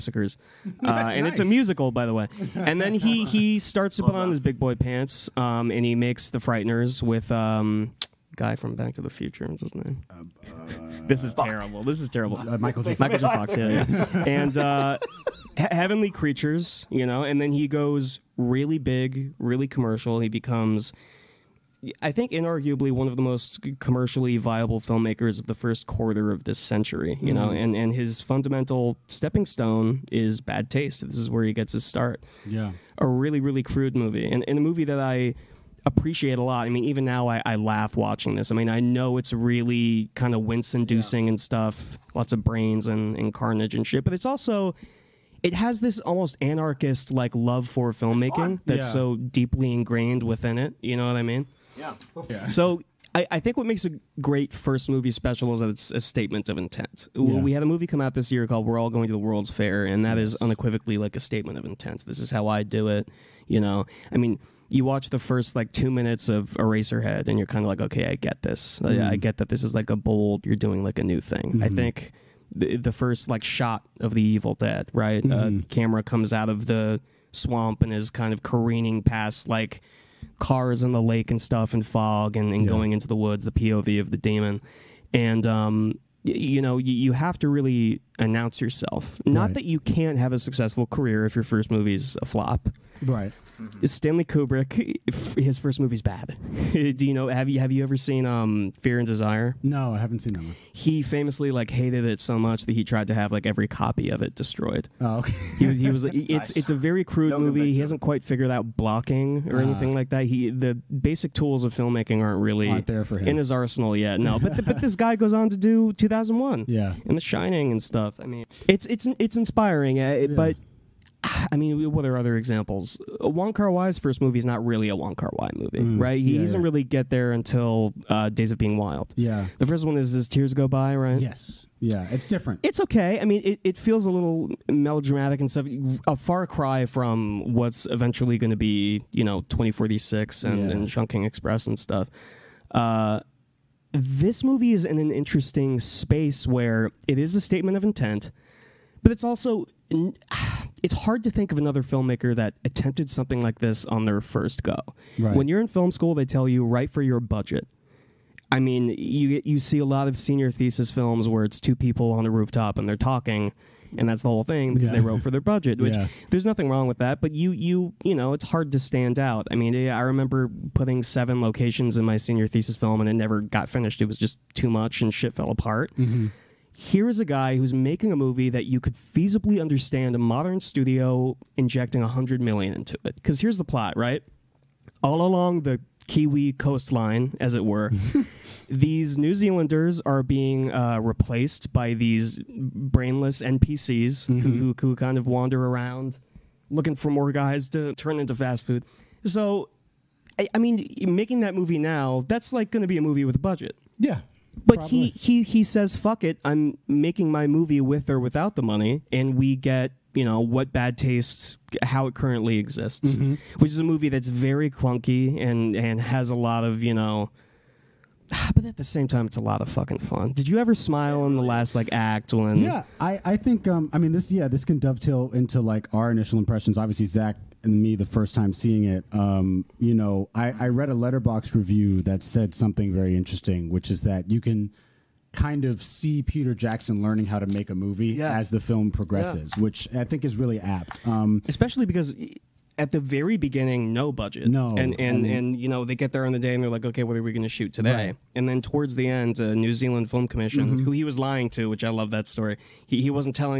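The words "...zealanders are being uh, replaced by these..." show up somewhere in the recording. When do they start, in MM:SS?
03:09.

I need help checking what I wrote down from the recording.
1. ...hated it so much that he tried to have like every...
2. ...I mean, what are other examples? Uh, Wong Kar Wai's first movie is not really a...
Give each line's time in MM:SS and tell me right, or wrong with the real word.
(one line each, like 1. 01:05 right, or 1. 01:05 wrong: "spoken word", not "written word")
1. 01:41 right
2. 02:01 right.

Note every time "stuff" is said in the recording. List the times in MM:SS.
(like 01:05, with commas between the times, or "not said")
00:41, 01:21, 01:57, 02:15, 02:21.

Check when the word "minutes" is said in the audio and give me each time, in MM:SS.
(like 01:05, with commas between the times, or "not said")
01:05.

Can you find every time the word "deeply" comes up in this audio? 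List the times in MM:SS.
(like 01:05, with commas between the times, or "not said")
00:49.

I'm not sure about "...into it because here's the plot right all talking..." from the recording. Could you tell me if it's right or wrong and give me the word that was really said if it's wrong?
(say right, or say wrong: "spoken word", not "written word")
wrong: "along", not "talking".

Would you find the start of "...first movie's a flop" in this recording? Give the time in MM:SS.
01:31.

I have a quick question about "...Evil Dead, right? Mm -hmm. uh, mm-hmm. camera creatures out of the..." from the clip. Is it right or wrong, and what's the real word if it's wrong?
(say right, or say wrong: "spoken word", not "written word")
wrong: "comes", not "creatures".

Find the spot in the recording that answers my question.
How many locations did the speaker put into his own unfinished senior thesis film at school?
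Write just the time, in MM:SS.
02:51.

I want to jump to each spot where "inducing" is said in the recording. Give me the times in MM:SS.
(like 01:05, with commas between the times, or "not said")
00:40.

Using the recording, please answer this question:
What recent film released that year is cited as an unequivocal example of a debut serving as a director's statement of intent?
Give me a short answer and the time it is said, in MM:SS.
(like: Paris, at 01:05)
We're All Going to the World's Fair, at 00:58.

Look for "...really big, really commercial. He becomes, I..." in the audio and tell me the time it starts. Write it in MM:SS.
00:18.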